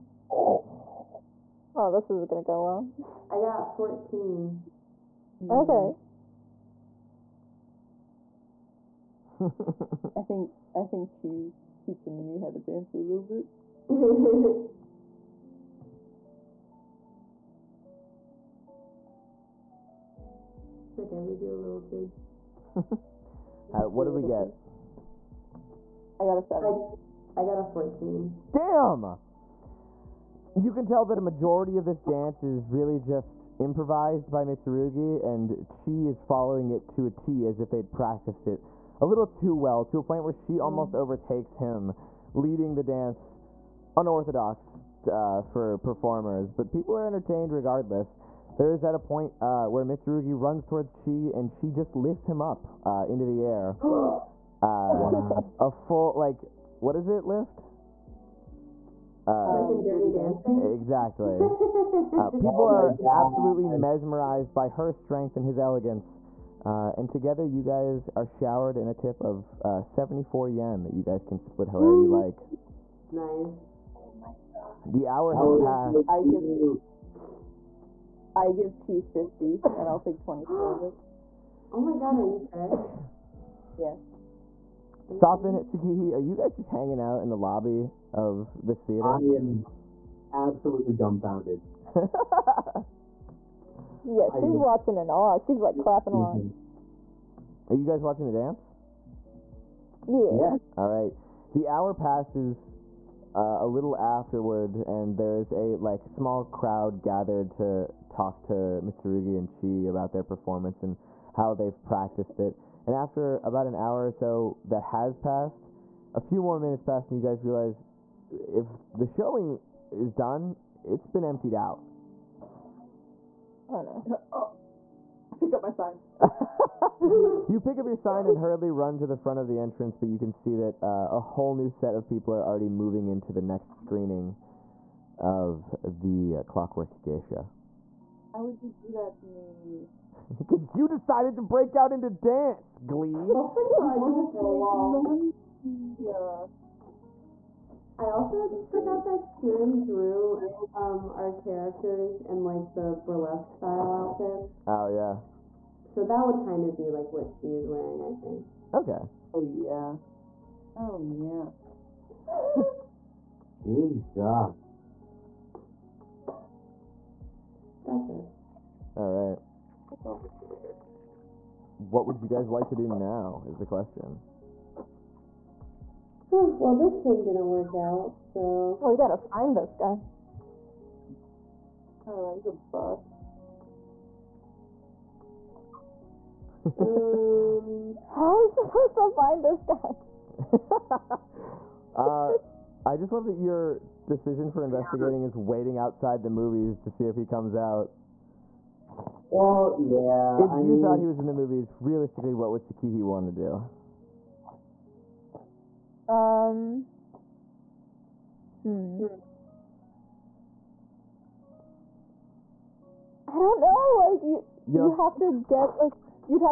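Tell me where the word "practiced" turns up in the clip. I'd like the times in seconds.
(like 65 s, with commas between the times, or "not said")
37 s, 111 s.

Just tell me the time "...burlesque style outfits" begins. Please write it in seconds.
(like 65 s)
153 s.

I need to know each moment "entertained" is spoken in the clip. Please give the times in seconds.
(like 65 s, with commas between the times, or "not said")
47 s.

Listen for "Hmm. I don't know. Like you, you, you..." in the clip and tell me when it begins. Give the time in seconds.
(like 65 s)
208 s.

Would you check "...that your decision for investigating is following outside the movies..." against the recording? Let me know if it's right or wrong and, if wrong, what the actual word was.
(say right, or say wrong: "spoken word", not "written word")
wrong: "waiting", not "following".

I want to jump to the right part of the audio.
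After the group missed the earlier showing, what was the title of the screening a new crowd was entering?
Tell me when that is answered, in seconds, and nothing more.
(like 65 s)
136 s.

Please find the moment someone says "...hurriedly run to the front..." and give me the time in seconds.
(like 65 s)
128 s.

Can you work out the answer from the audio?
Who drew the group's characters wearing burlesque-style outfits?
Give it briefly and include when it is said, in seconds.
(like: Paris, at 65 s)
Kieran, at 149 s.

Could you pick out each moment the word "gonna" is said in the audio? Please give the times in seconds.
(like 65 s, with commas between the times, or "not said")
2 s.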